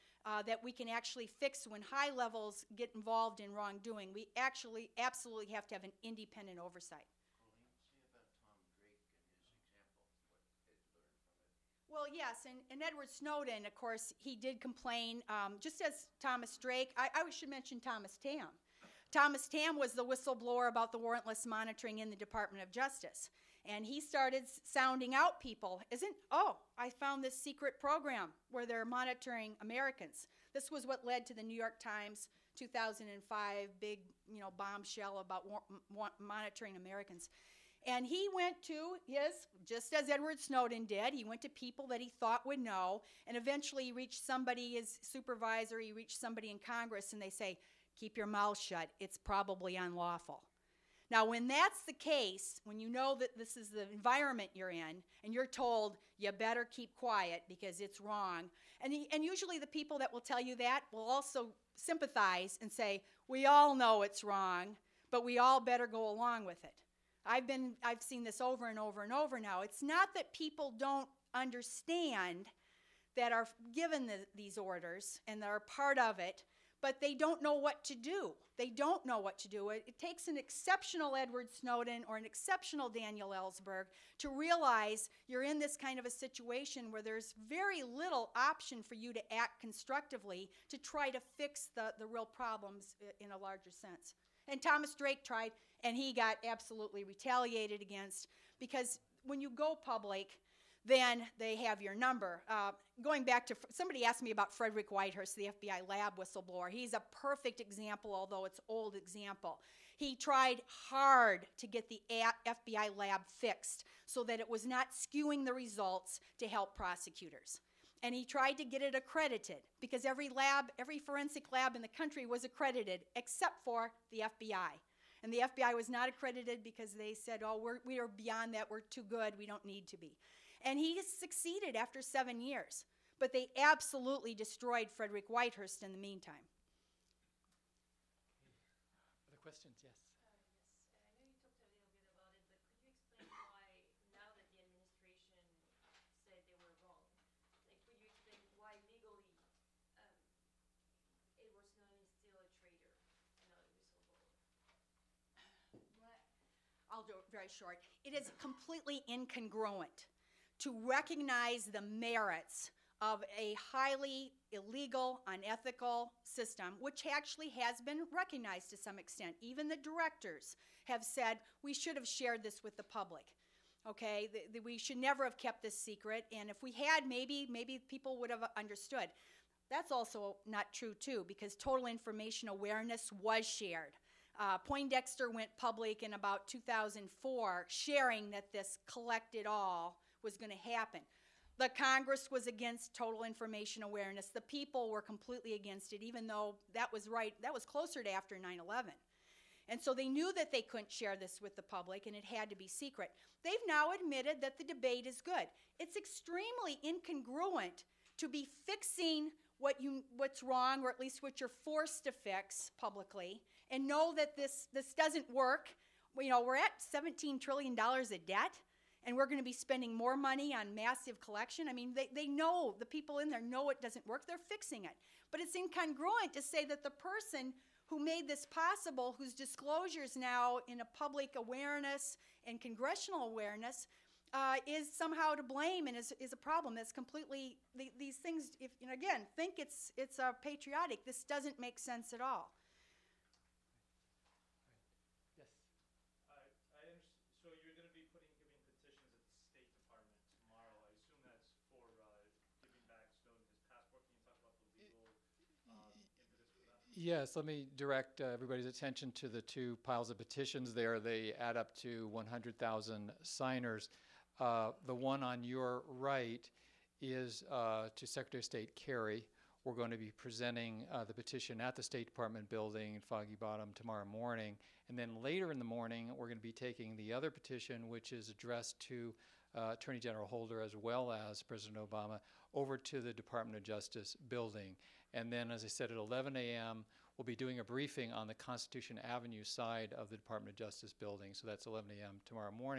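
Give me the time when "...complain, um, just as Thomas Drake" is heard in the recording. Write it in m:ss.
0:14.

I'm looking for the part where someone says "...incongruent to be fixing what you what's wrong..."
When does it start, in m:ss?
3:26.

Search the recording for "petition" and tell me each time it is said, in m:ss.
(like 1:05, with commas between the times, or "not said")
4:20, 4:31, 4:37.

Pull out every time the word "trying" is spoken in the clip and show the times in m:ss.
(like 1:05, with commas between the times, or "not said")
not said.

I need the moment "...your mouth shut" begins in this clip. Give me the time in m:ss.
0:48.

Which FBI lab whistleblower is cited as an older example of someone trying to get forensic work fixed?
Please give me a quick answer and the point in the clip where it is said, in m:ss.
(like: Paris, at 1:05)
Frederick Whitehurst, at 1:44.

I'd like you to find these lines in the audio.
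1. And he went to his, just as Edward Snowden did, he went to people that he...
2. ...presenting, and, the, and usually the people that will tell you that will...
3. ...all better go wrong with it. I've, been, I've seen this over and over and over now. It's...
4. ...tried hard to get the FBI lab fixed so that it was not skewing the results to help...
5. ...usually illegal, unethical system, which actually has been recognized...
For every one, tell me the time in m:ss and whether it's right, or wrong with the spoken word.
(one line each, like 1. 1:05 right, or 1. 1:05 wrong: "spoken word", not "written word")
1. 0:37 right
2. 0:58 wrong: "wrong", not "presenting"
3. 1:05 wrong: "along", not "wrong"
4. 1:50 right
5. 2:43 wrong: "highly", not "usually".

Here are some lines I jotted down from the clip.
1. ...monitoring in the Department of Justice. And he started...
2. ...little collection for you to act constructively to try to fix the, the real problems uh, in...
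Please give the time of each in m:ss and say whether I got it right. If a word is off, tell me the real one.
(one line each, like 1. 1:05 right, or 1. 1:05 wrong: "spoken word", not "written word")
1. 0:21 right
2. 1:27 wrong: "option", not "collection".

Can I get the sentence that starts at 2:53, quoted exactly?
Okay, we should never have kept this secret, and if we had, maybe maybe people would have understood.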